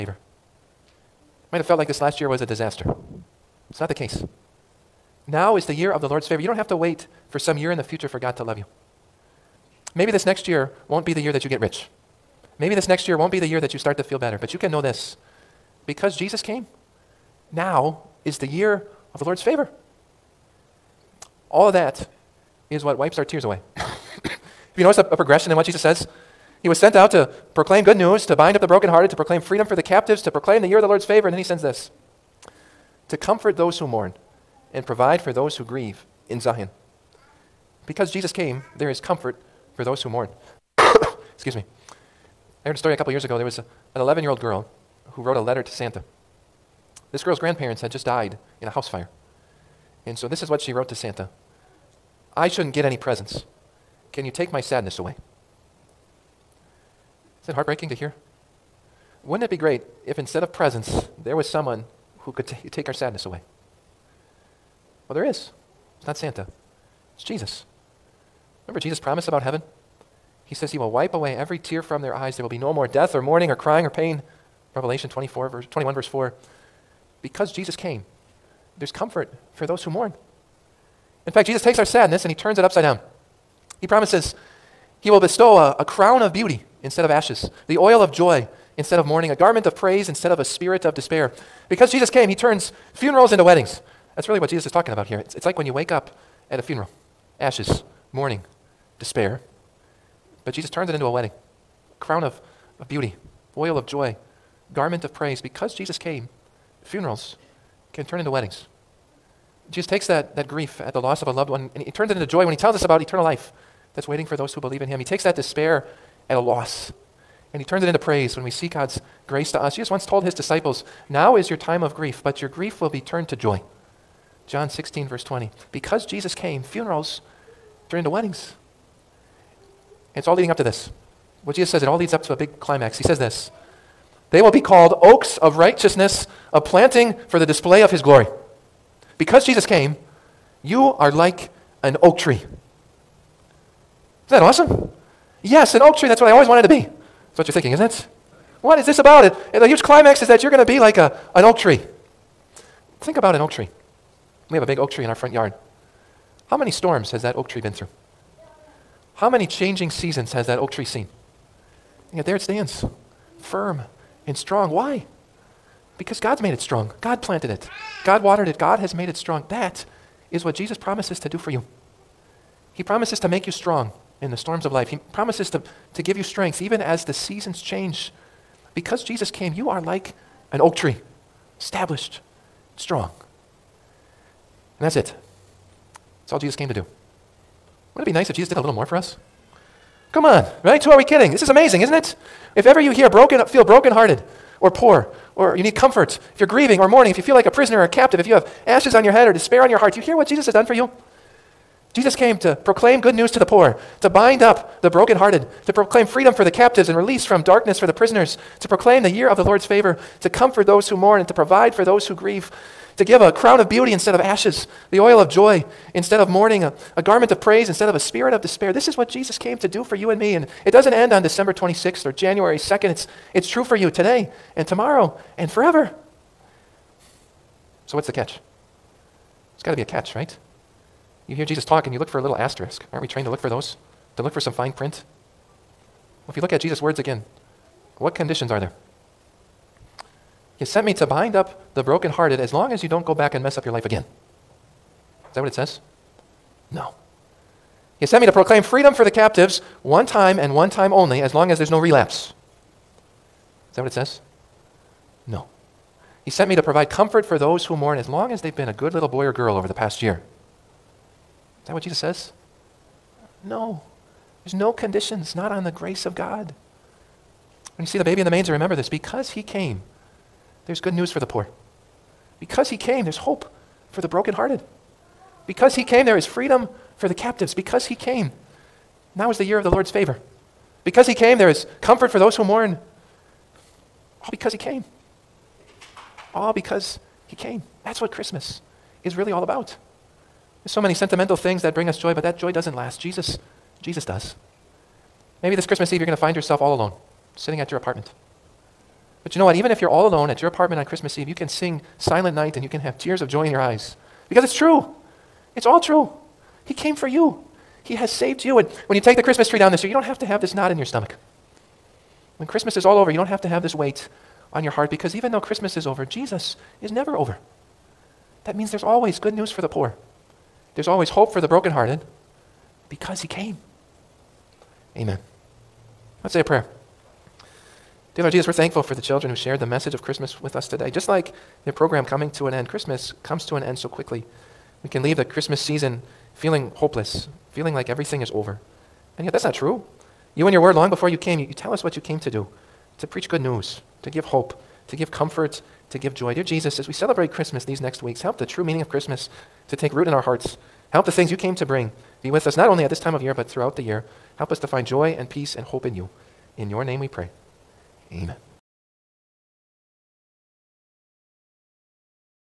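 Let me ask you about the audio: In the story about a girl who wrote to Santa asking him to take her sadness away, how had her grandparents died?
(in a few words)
In a house fire.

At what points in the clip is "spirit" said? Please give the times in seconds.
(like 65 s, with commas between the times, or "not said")
90 s, 217 s.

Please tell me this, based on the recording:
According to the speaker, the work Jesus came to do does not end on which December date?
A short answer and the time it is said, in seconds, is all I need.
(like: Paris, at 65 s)
December 26th, at 221 s.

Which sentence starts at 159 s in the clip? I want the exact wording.
How many changing seasons has that oak tree seen?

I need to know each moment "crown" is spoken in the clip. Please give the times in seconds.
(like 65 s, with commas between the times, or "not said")
85 s, 102 s, 213 s.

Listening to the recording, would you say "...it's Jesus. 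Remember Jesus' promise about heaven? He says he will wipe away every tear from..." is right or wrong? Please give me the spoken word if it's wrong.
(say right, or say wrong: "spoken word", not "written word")
right.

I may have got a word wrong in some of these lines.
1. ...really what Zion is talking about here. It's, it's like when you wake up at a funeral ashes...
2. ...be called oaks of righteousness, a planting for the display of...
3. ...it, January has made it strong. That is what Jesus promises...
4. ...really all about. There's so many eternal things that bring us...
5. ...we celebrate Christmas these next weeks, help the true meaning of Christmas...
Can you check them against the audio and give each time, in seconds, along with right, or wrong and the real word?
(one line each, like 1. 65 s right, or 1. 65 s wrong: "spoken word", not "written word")
1. 94 s wrong: "Jesus", not "Zion"
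2. 134 s right
3. 168 s wrong: "God", not "January"
4. 289 s wrong: "sentimental", not "eternal"
5. 346 s right.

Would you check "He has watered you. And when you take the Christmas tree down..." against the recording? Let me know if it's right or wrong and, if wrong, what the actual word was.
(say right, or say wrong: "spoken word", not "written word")
wrong: "saved", not "watered".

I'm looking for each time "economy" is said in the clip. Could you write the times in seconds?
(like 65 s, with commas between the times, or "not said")
not said.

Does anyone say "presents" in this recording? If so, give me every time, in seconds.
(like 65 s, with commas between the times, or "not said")
52 s, 60 s.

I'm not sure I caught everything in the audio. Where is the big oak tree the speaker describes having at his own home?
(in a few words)
Front yard.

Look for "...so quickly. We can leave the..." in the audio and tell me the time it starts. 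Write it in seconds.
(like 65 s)
333 s.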